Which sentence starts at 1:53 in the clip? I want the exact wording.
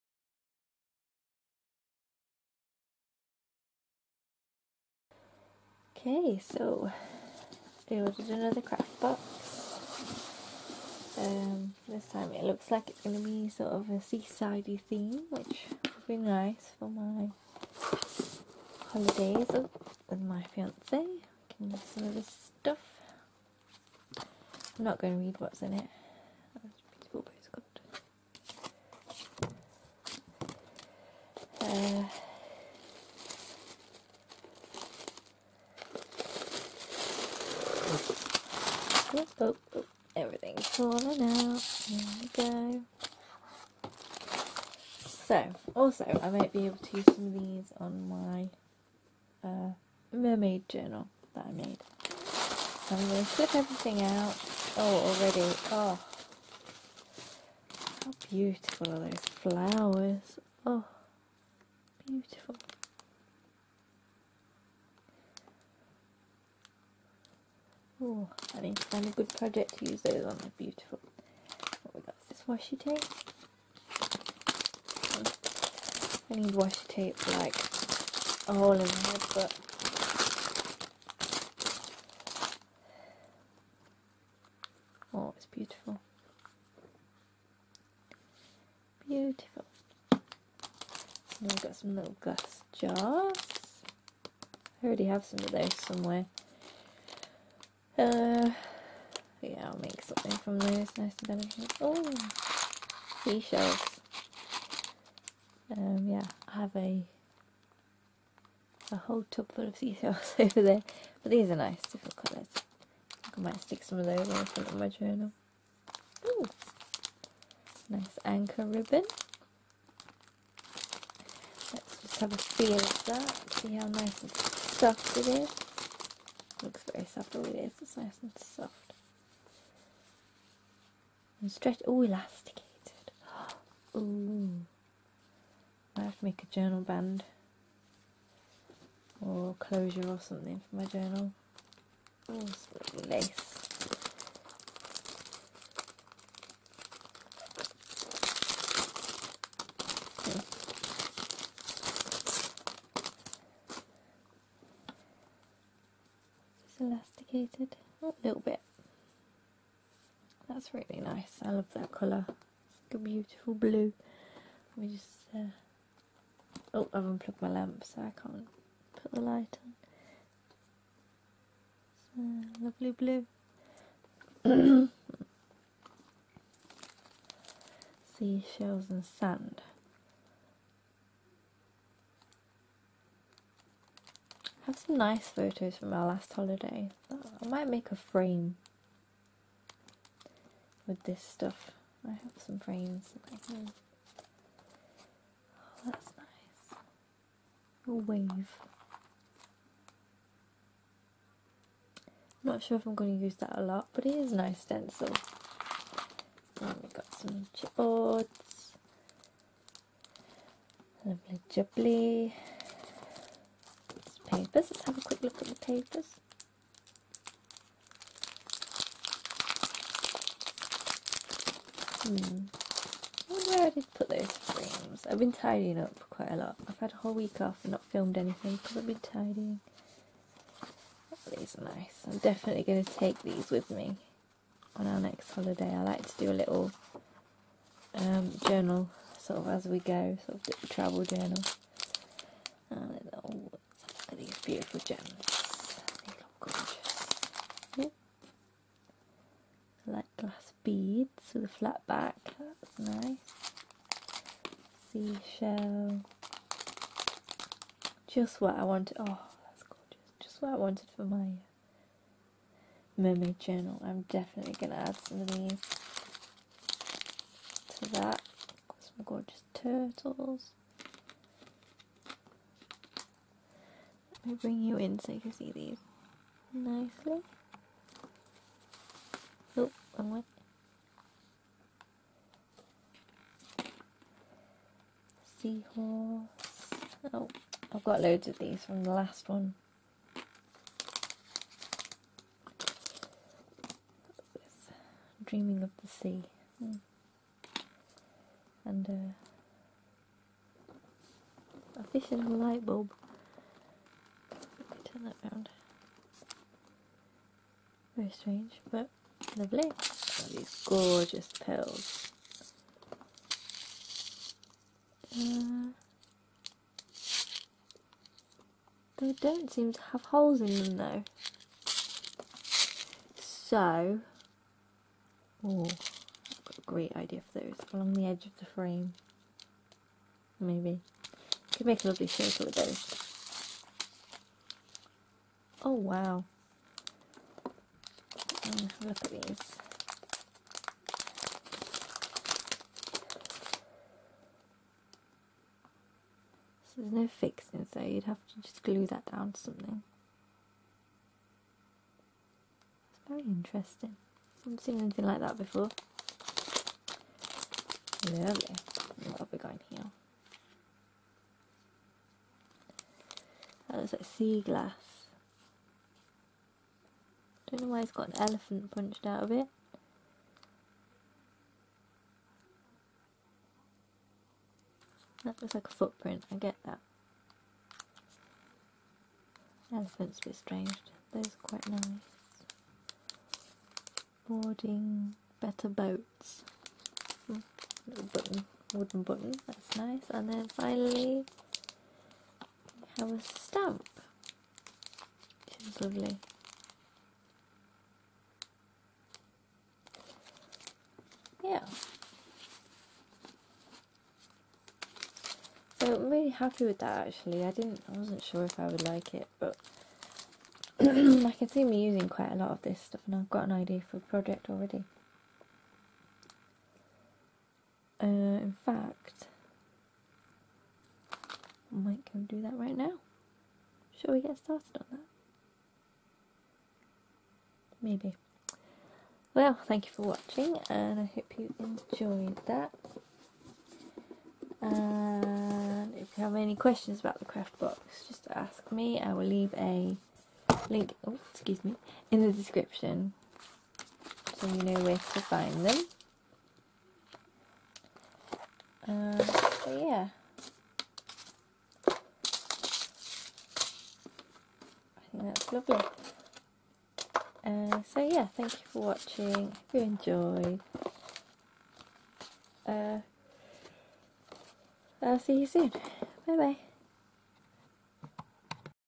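I might stick some of those on the front of my journal.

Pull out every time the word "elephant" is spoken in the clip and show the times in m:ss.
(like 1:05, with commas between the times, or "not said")
6:08, 6:19.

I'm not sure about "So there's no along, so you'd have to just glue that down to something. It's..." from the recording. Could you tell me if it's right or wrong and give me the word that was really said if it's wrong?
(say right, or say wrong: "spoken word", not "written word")
wrong: "fixing", not "along".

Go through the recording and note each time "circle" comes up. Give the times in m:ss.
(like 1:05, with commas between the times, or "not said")
5:32.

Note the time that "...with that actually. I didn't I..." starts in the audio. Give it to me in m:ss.
6:46.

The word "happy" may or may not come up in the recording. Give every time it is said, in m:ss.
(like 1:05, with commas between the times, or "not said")
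6:46.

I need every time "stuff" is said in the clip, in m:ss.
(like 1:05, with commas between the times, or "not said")
0:22, 3:11, 6:52.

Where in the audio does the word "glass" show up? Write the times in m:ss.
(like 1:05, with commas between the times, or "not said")
1:32, 4:10, 6:04.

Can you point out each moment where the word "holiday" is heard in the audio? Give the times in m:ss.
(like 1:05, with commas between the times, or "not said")
0:18, 3:06, 3:55.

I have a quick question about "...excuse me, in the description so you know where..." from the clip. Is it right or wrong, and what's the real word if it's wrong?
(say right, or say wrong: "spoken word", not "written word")
right.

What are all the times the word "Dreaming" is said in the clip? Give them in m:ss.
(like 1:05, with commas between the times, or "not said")
4:55.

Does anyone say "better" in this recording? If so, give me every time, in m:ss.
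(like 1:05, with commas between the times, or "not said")
6:25.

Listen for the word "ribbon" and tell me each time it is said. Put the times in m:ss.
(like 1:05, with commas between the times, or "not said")
1:58.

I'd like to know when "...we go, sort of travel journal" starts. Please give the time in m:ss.
3:59.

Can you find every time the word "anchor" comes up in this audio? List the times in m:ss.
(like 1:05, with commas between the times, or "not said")
1:58.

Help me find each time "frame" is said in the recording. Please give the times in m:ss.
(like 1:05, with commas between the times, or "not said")
3:07, 3:12, 3:44, 5:28.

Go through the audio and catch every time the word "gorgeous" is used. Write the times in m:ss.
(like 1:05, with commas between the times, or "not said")
4:19, 4:29, 5:10.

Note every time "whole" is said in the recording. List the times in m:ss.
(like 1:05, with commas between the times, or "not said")
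1:48, 3:46.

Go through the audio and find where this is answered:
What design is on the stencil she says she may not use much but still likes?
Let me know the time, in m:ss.
3:17.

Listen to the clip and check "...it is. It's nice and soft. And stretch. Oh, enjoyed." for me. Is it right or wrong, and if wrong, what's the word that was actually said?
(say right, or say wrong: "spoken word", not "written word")
wrong: "elasticated", not "enjoyed".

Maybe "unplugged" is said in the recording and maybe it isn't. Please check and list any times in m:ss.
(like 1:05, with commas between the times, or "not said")
2:47.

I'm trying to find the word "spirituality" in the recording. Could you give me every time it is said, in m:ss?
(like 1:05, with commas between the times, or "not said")
not said.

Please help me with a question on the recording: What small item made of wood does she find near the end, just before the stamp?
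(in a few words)
Wooden button.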